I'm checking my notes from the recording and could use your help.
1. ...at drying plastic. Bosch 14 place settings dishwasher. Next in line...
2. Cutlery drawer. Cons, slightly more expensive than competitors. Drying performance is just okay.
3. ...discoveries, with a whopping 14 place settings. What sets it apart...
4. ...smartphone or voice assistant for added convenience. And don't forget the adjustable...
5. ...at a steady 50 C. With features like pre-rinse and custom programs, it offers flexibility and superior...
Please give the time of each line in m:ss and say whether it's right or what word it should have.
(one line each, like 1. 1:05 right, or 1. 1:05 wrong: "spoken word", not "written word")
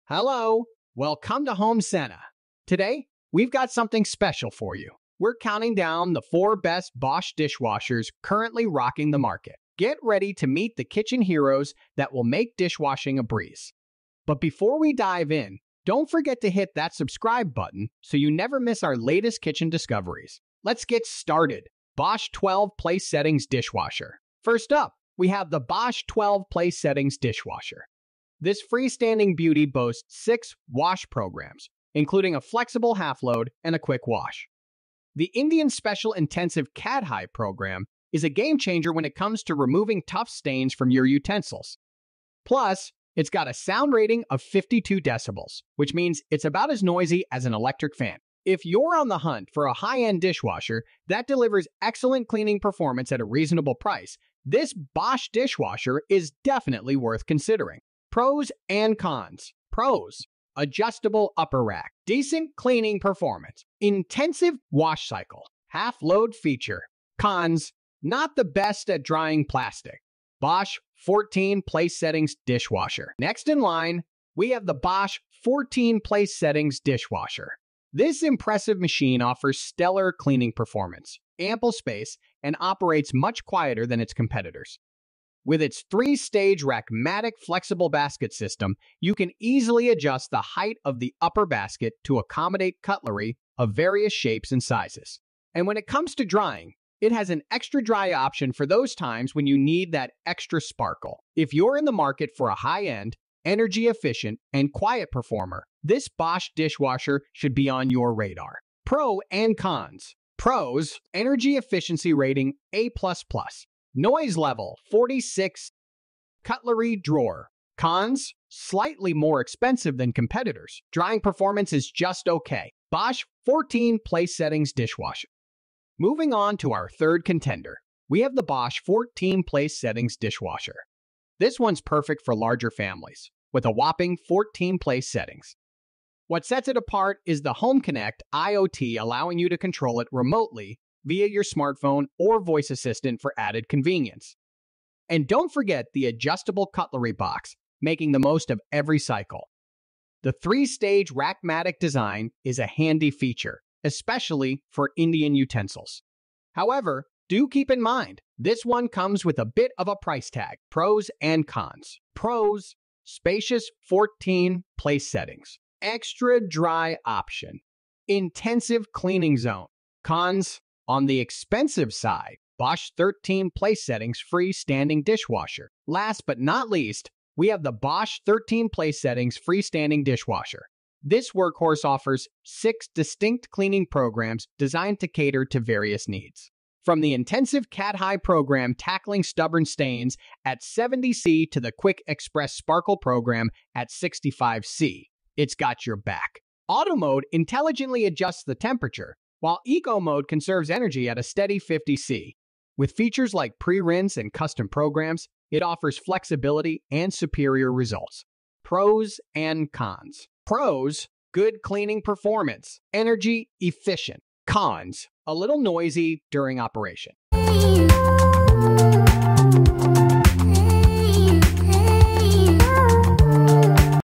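1. 1:08 right
2. 1:56 right
3. 2:12 wrong: "families", not "discoveries"
4. 2:21 right
5. 3:21 right.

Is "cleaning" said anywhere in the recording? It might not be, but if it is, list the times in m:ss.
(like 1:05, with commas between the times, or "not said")
0:52, 1:02, 1:20, 2:48, 3:03, 3:31.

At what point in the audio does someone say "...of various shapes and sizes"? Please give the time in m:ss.
1:33.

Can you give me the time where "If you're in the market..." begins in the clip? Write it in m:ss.
1:41.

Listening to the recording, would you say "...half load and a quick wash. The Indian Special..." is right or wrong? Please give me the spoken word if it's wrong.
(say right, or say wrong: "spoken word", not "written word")
right.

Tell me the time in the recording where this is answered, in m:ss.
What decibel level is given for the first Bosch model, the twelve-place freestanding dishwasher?
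0:44.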